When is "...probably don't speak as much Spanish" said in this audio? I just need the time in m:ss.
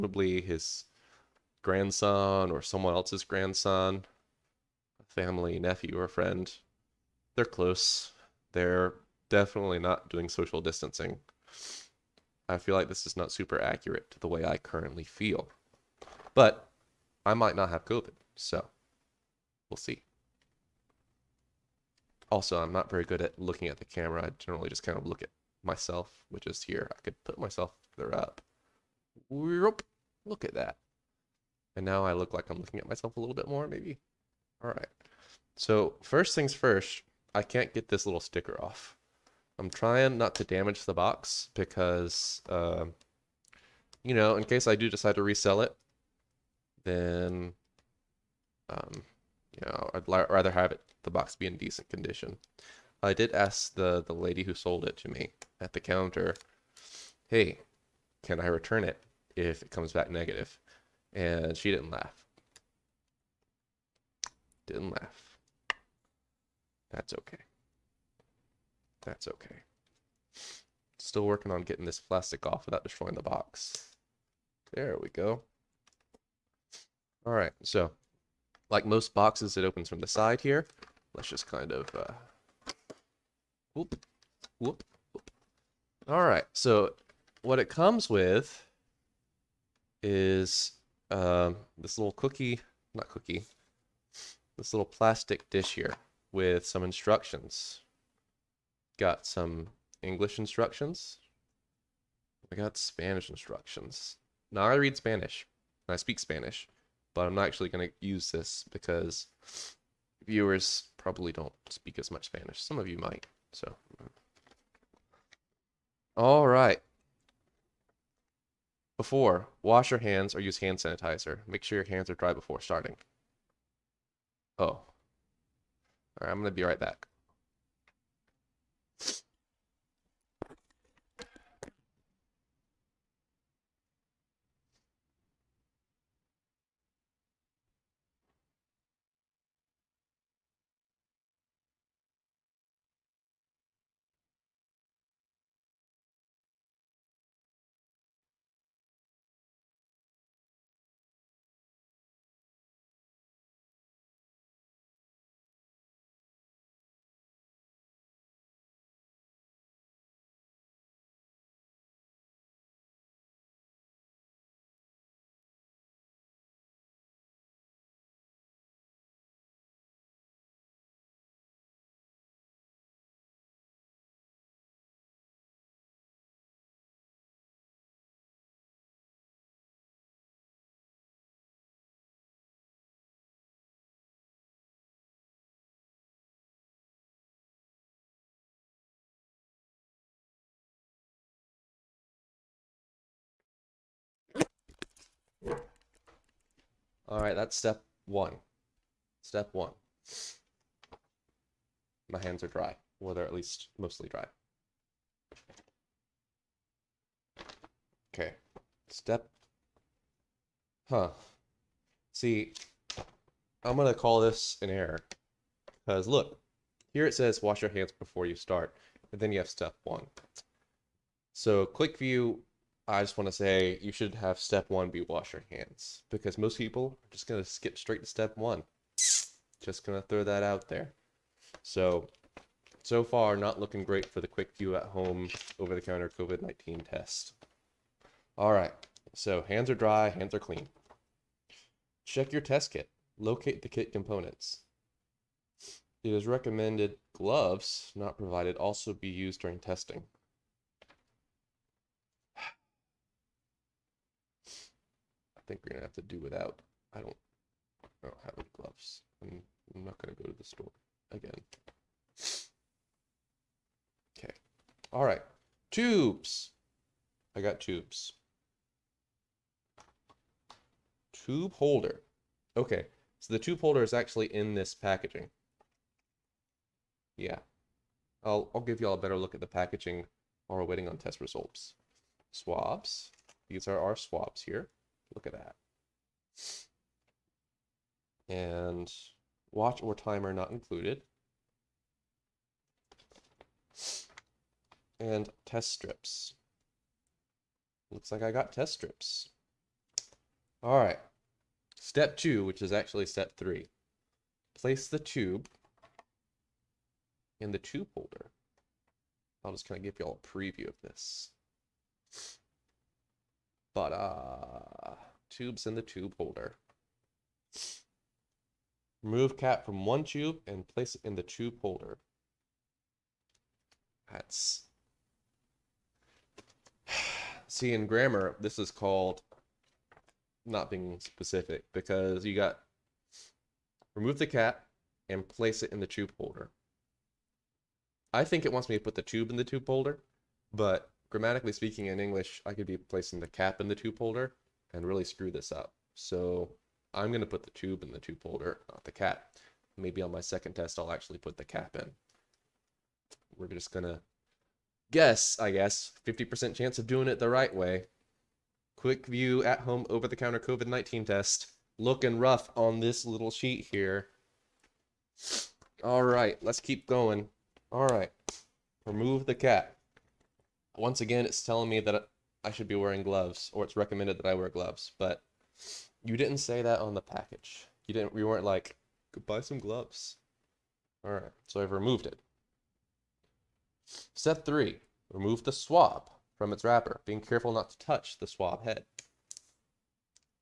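1:50.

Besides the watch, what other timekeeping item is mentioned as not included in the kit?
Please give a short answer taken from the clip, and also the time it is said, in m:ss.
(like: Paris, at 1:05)
Timer, at 4:49.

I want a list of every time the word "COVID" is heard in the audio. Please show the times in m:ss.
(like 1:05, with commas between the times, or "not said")
0:17, 3:56, 6:00.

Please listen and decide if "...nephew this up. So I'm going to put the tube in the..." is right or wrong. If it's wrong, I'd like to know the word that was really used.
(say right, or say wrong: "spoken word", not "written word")
wrong: "screw", not "nephew".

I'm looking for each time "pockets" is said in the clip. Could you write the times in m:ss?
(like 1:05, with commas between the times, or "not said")
not said.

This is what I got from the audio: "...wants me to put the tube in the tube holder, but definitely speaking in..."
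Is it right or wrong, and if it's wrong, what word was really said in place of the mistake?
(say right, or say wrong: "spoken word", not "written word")
wrong: "grammatically", not "definitely".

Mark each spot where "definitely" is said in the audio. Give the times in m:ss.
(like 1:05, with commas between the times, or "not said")
0:09.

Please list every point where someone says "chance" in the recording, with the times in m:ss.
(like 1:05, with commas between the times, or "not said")
5:56.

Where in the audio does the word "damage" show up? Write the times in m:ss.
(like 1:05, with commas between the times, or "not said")
0:40.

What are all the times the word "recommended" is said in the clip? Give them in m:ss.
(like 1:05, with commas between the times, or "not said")
4:06, 6:13.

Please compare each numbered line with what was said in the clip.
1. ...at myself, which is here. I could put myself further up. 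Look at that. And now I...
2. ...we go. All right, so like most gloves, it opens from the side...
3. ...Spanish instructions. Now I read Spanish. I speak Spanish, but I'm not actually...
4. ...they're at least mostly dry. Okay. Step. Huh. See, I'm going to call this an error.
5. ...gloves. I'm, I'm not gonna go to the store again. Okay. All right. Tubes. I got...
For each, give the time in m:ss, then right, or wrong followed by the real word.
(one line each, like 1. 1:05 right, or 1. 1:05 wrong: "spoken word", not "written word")
1. 0:25 right
2. 1:15 wrong: "boxes", not "gloves"
3. 1:42 right
4. 3:23 right
5. 4:18 right.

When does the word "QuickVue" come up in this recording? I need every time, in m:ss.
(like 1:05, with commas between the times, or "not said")
3:41, 3:54, 5:58.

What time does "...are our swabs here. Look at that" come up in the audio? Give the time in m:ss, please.
4:43.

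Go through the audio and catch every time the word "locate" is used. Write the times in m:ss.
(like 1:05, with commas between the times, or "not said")
4:03.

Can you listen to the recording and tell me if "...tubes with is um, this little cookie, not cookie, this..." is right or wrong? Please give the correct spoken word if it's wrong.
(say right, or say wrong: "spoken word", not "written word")
wrong: "comes", not "tubes".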